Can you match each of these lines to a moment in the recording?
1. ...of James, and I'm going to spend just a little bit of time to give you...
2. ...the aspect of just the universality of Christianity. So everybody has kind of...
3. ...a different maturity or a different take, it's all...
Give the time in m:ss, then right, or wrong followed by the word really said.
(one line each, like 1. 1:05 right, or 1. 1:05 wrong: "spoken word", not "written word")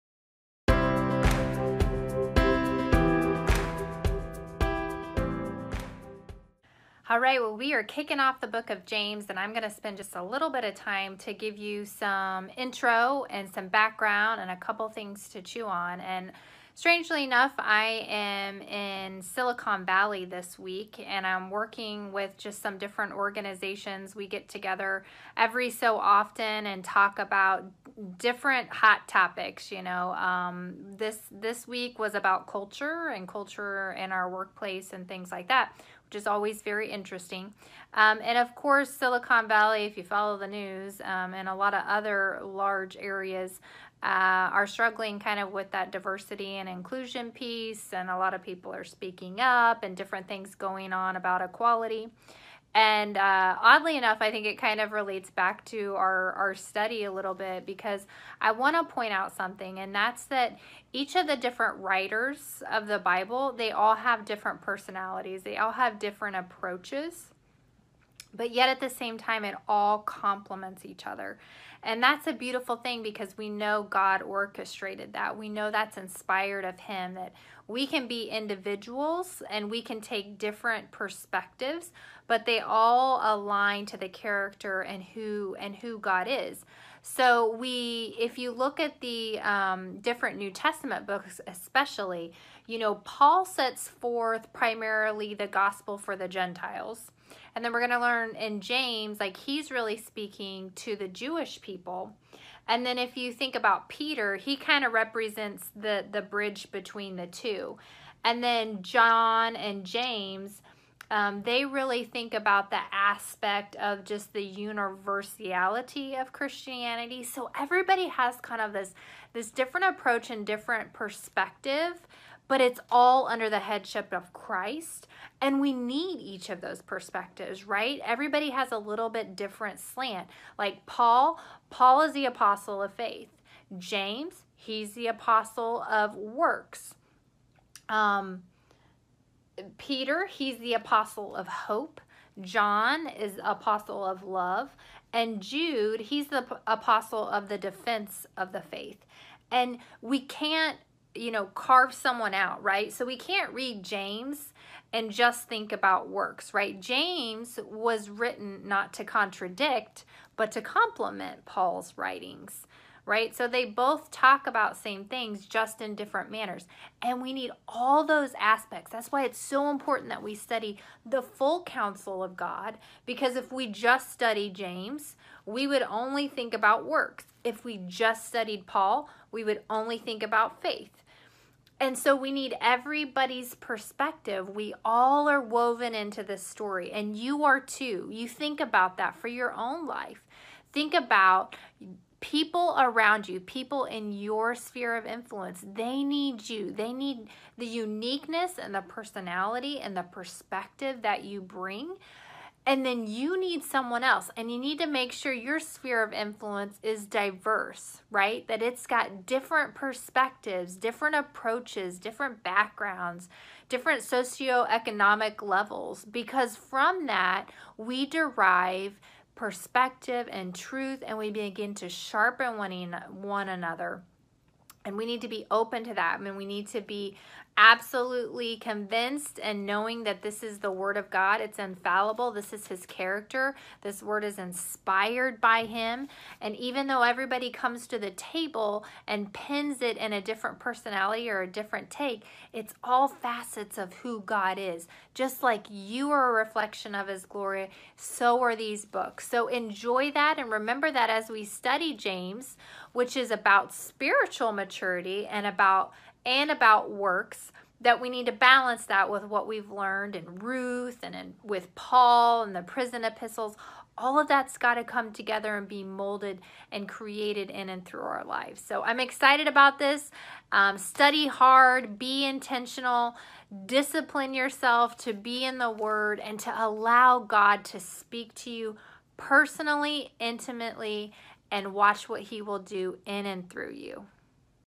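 1. 0:08 right
2. 1:52 right
3. 4:00 wrong: "personality", not "maturity".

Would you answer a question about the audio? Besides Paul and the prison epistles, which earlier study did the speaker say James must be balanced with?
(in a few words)
Ruth.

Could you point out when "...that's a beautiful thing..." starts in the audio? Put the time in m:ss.
1:12.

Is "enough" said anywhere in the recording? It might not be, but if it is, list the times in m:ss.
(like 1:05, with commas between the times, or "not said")
0:17, 0:53.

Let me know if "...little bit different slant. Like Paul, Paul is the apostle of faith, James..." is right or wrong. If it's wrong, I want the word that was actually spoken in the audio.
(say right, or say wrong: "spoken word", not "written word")
right.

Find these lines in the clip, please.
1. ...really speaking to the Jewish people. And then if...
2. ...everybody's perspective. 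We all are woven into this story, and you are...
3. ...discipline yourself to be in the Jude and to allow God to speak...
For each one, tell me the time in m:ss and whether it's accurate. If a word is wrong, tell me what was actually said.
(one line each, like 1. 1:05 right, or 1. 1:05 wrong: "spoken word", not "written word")
1. 1:39 right
2. 3:02 right
3. 4:33 wrong: "Word", not "Jude".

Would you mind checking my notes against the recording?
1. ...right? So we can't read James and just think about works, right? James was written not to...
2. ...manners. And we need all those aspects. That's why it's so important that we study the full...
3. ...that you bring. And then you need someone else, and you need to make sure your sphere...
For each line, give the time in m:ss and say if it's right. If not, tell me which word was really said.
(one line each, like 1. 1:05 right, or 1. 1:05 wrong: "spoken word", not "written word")
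1. 2:32 right
2. 2:46 right
3. 3:21 right.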